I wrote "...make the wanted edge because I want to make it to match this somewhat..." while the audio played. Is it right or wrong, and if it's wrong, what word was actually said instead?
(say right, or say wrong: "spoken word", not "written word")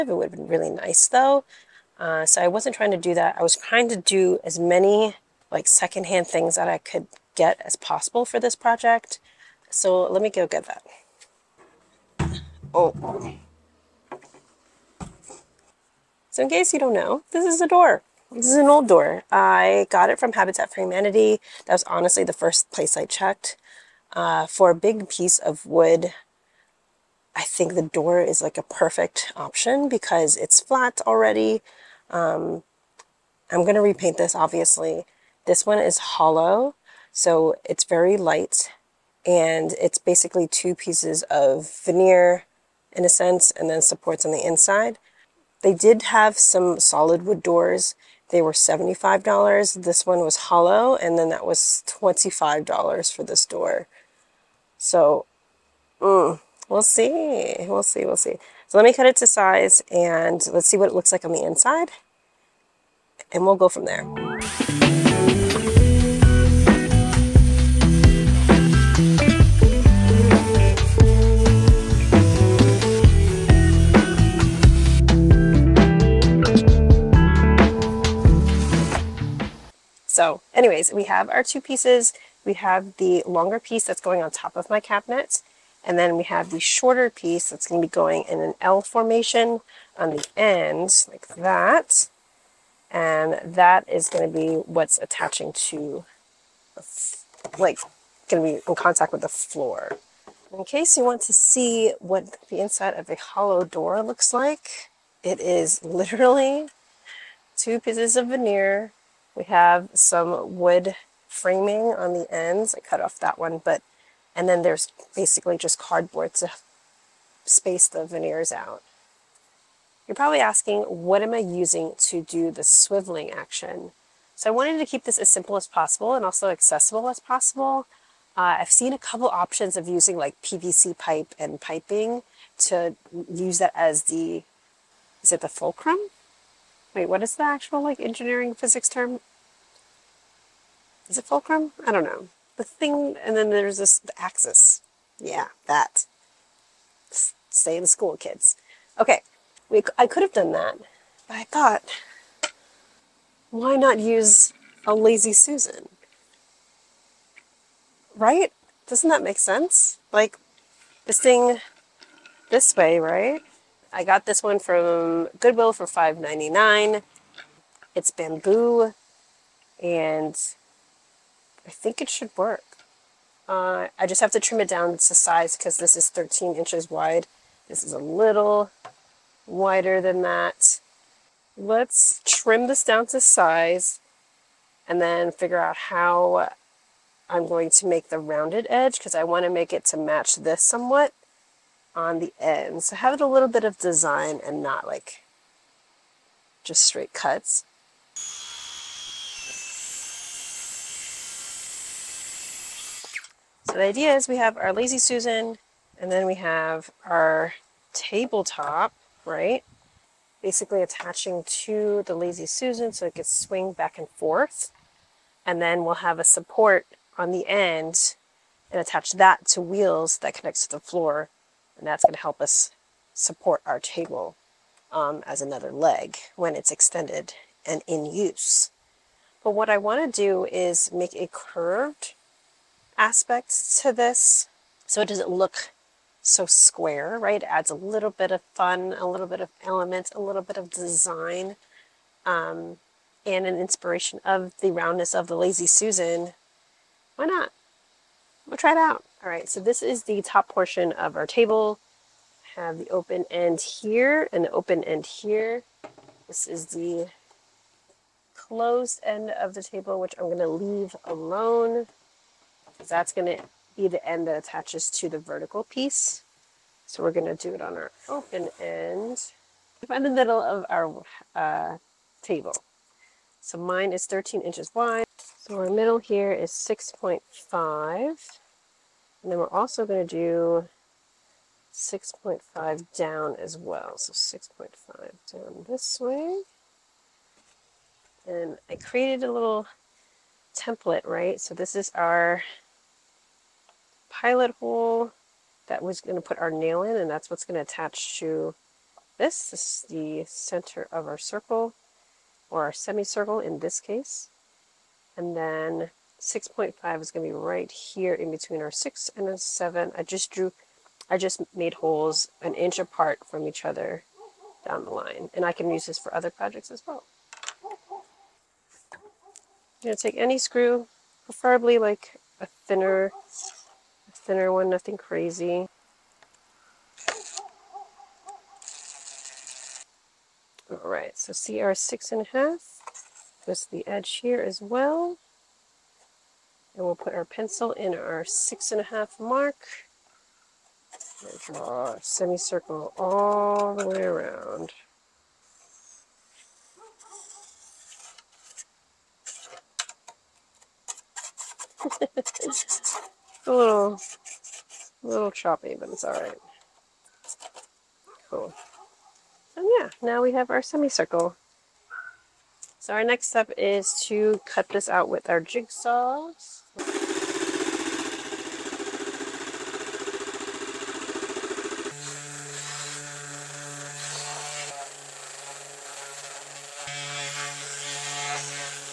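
wrong: "rounded", not "wanted".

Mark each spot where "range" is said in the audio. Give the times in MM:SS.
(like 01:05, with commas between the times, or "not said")
not said.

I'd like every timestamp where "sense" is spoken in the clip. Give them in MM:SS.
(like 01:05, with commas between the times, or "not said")
00:43, 02:39.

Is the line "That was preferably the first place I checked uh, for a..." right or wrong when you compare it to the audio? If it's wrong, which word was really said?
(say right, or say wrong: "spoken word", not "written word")
wrong: "honestly", not "preferably".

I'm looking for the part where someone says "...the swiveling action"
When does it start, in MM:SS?
02:02.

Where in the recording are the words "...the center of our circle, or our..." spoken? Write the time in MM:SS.
04:59.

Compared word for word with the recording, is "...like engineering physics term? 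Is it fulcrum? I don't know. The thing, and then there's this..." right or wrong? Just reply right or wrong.
right.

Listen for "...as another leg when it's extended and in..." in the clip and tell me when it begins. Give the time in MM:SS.
03:45.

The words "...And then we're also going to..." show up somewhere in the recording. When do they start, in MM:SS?
04:39.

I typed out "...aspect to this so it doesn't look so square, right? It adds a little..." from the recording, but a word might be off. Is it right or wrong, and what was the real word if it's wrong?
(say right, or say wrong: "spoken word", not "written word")
right.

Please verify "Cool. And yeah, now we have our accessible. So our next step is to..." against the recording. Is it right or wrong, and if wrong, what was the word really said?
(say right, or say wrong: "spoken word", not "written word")
wrong: "semicircle", not "accessible".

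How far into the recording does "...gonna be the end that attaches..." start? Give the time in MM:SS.
04:23.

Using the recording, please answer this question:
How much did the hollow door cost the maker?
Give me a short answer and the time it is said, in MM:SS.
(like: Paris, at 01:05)
$25, at 00:51.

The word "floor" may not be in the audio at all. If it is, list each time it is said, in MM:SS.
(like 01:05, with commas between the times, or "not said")
01:39, 03:40.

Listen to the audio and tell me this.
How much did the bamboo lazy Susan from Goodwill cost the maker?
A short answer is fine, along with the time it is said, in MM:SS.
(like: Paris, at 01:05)
$5.99, at 02:45.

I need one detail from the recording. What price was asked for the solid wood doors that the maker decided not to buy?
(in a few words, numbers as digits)
$75.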